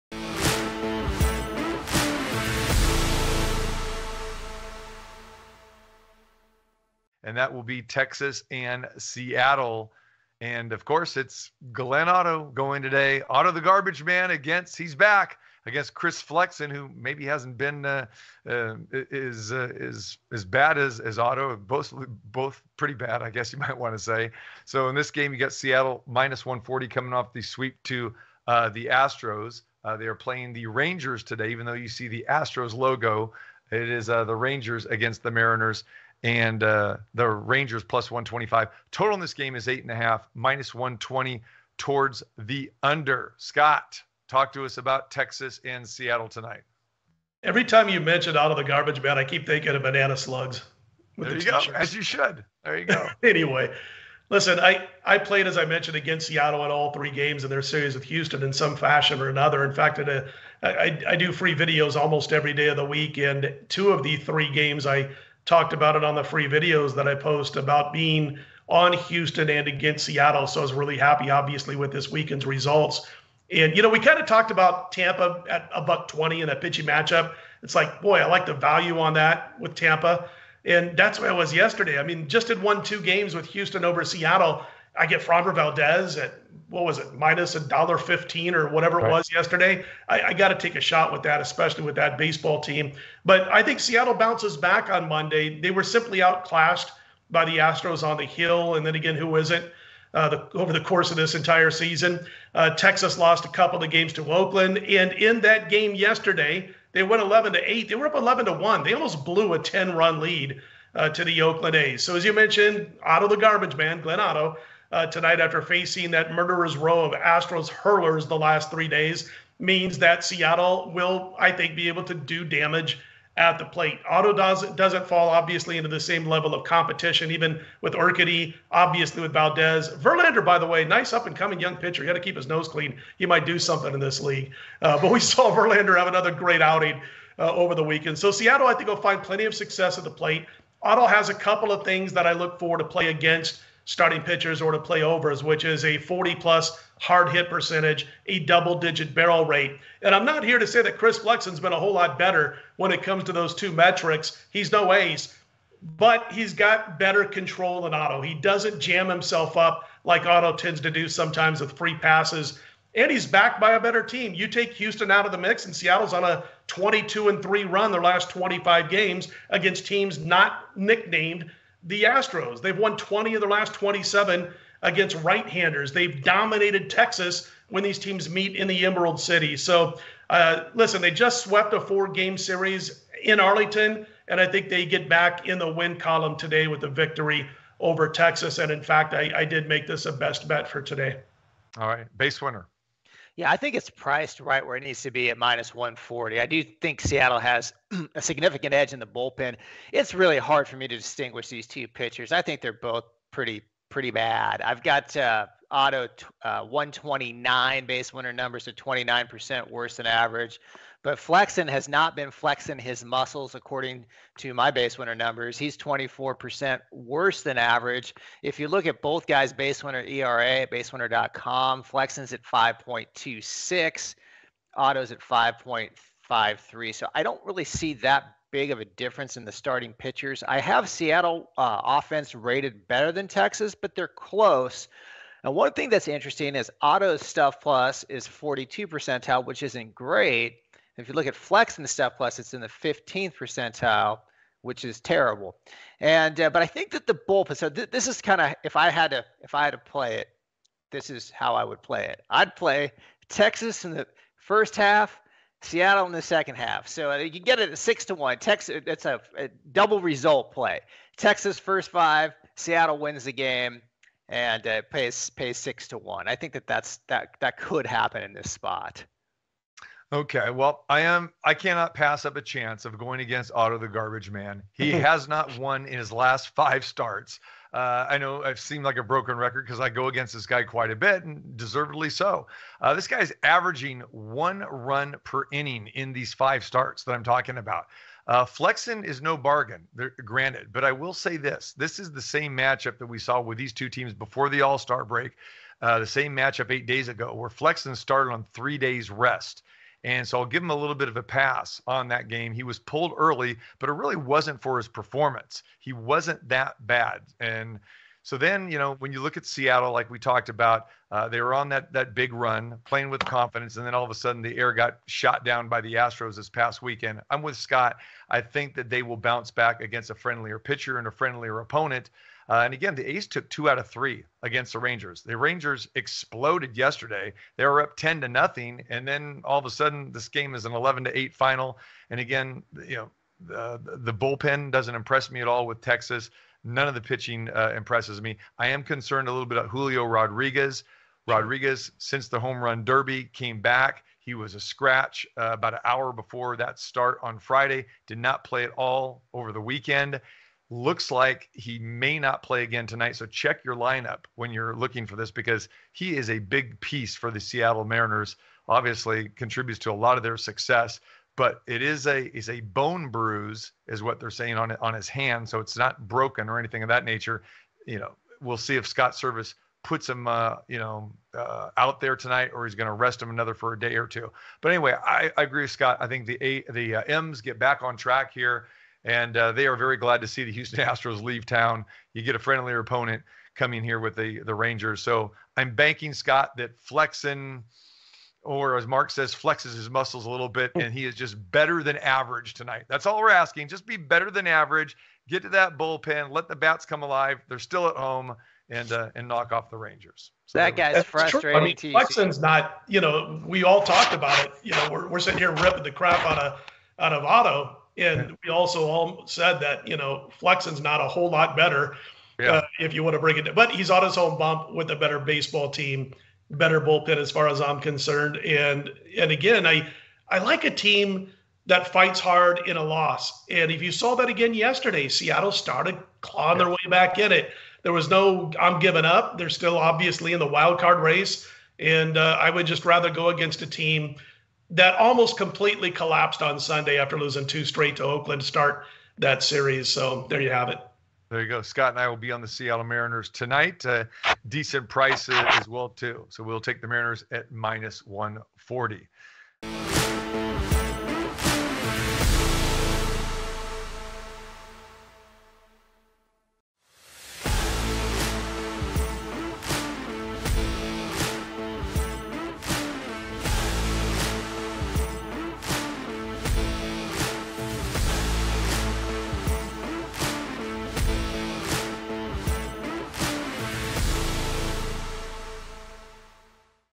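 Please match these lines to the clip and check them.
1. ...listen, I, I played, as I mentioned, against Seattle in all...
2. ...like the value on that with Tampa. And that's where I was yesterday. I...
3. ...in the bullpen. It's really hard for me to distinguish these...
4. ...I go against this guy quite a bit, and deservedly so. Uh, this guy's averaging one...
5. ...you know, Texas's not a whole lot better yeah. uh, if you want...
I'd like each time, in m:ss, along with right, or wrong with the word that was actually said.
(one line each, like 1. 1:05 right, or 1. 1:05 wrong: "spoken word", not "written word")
1. 0:54 right
2. 1:18 right
3. 3:18 right
4. 4:39 right
5. 6:49 wrong: "Flexen", not "Texas".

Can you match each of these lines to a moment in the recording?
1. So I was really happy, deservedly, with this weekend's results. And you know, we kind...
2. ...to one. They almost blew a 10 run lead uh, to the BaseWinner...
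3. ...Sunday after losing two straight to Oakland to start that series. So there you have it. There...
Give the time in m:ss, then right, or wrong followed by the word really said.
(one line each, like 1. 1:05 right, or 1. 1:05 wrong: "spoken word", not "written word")
1. 1:10 wrong: "obviously", not "deservedly"
2. 1:48 wrong: "Oakland", not "BaseWinner"
3. 7:16 right.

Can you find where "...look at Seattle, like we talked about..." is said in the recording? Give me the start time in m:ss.
5:09.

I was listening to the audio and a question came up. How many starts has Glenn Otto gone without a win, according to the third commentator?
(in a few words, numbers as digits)
5.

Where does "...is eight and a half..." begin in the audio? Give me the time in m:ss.
0:39.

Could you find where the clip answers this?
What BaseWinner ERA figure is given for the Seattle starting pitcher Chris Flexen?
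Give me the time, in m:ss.
3:42.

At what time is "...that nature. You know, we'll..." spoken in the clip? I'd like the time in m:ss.
6:06.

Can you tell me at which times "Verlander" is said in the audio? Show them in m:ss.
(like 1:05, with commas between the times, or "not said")
2:09, 2:15.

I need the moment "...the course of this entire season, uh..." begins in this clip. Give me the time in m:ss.
1:40.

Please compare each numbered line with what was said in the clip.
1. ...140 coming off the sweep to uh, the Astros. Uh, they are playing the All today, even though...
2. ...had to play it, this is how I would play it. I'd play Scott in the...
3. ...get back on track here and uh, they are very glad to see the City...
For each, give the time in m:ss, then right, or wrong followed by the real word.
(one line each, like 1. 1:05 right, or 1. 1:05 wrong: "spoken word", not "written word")
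1. 0:26 wrong: "Rangers", not "All"
2. 4:09 wrong: "Texas", not "Scott"
3. 6:17 wrong: "Houston", not "City".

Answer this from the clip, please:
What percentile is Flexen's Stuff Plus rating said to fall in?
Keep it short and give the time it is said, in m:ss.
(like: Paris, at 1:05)
15th, at 4:02.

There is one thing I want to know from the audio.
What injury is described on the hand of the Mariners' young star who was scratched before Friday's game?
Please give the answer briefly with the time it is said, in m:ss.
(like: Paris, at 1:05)
bone bruise, at 6:02.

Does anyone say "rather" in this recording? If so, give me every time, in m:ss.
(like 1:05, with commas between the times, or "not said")
7:12.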